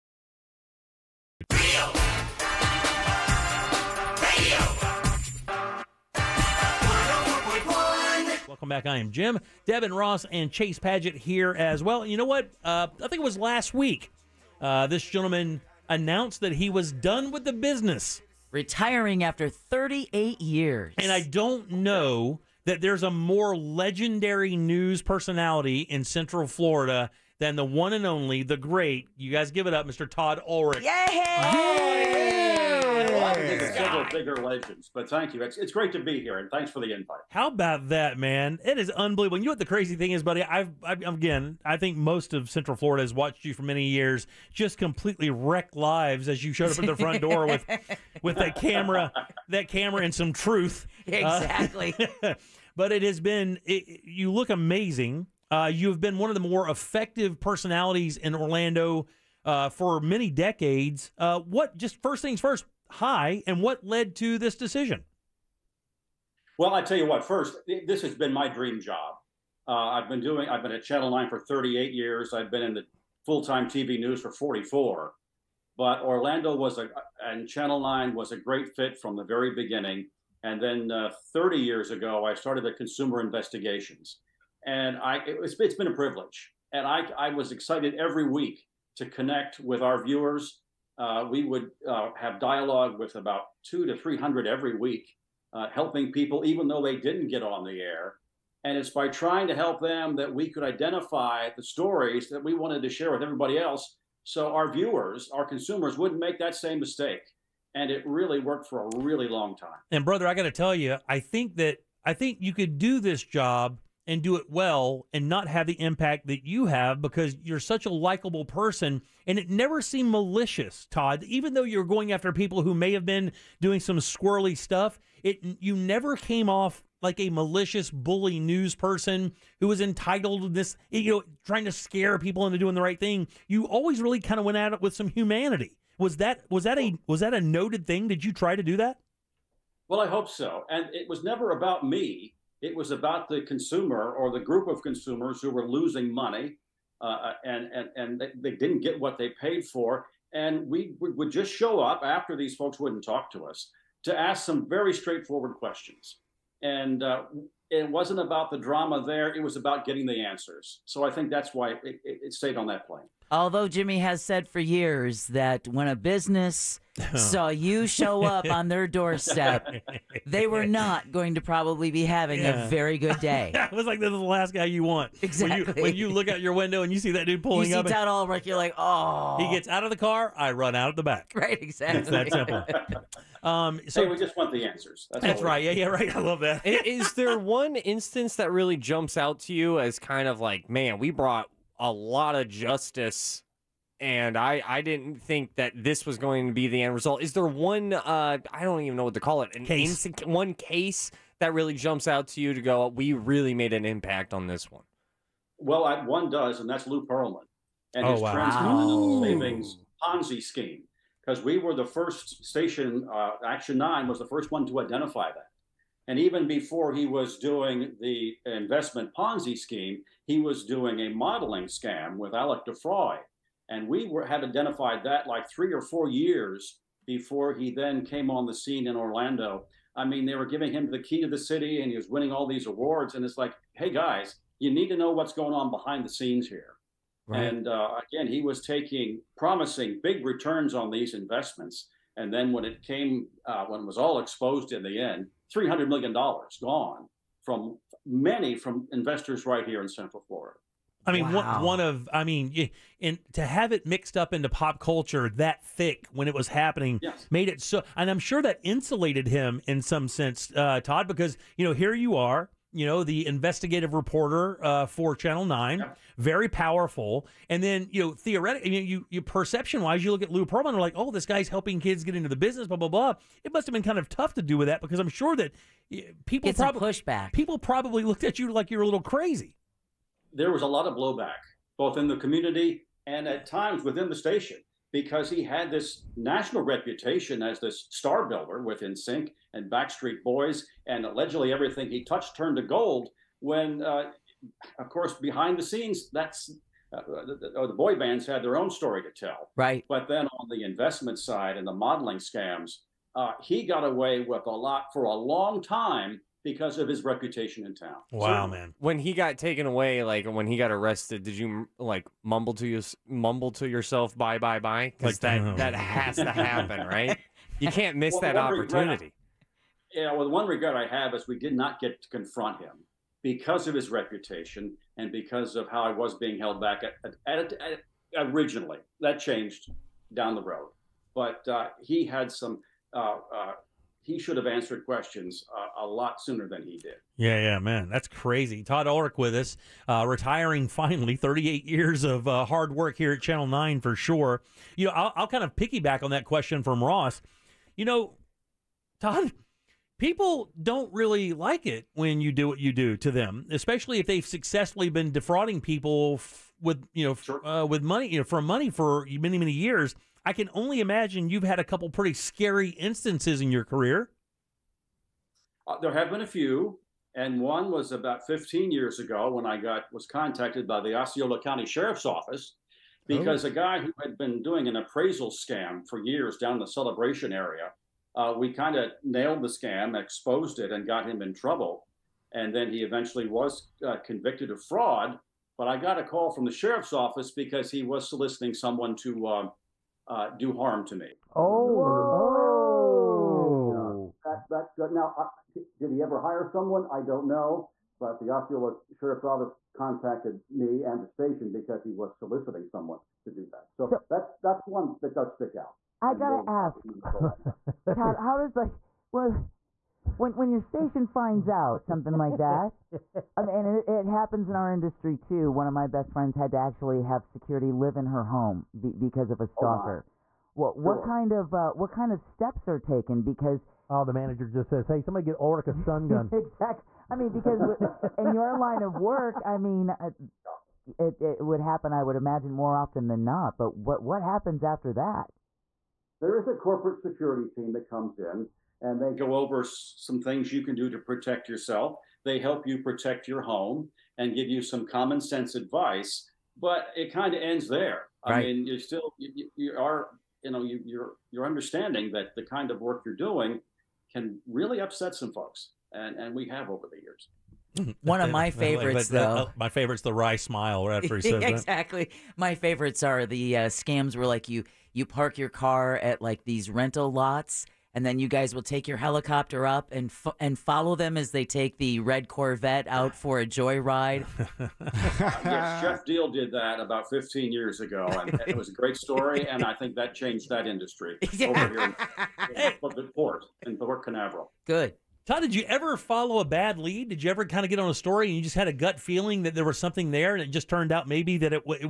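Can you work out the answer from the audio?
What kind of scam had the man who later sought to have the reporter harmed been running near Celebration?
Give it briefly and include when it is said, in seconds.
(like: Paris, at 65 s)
appraisal scam, at 374 s.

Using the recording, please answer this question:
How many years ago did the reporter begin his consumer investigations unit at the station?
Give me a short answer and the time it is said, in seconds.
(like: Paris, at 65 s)
30 years, at 81 s.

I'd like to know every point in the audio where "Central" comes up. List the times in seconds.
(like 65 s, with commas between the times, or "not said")
26 s, 42 s, 249 s.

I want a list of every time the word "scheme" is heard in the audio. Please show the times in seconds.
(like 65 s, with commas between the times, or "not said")
210 s, 219 s.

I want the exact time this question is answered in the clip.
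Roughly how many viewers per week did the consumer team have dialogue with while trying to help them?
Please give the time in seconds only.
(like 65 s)
93 s.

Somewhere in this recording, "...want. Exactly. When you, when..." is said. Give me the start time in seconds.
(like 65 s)
174 s.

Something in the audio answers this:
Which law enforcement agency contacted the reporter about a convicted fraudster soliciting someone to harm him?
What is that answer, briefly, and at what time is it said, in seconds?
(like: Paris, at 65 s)
Osceola County Sheriff's Office, at 370 s.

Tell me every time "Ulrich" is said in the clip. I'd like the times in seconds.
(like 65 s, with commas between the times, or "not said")
30 s, 178 s, 338 s, 425 s.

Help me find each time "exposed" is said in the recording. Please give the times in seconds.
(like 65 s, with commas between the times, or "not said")
244 s, 380 s.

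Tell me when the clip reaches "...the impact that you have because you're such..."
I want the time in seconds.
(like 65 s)
115 s.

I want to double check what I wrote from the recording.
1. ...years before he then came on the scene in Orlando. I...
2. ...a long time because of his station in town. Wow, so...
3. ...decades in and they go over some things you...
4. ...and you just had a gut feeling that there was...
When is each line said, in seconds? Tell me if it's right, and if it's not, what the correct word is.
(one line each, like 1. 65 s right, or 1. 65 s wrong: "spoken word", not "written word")
1. 226 s right
2. 305 s wrong: "reputation", not "station"
3. 437 s wrong: "comes", not "decades"
4. 488 s right.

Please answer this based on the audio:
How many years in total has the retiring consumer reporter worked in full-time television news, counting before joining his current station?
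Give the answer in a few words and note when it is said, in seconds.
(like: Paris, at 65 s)
44, at 74 s.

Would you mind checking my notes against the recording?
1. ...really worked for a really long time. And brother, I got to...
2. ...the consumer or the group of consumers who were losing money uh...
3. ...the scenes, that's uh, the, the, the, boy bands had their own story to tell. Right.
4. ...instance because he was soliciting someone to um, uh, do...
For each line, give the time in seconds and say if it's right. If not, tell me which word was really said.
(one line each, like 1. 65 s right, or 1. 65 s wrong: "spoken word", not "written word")
1. 108 s right
2. 143 s right
3. 295 s right
4. 386 s wrong: "office", not "instance".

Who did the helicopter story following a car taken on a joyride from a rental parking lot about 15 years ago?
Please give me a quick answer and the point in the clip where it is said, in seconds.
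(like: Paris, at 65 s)
Jeff Deal, at 475 s.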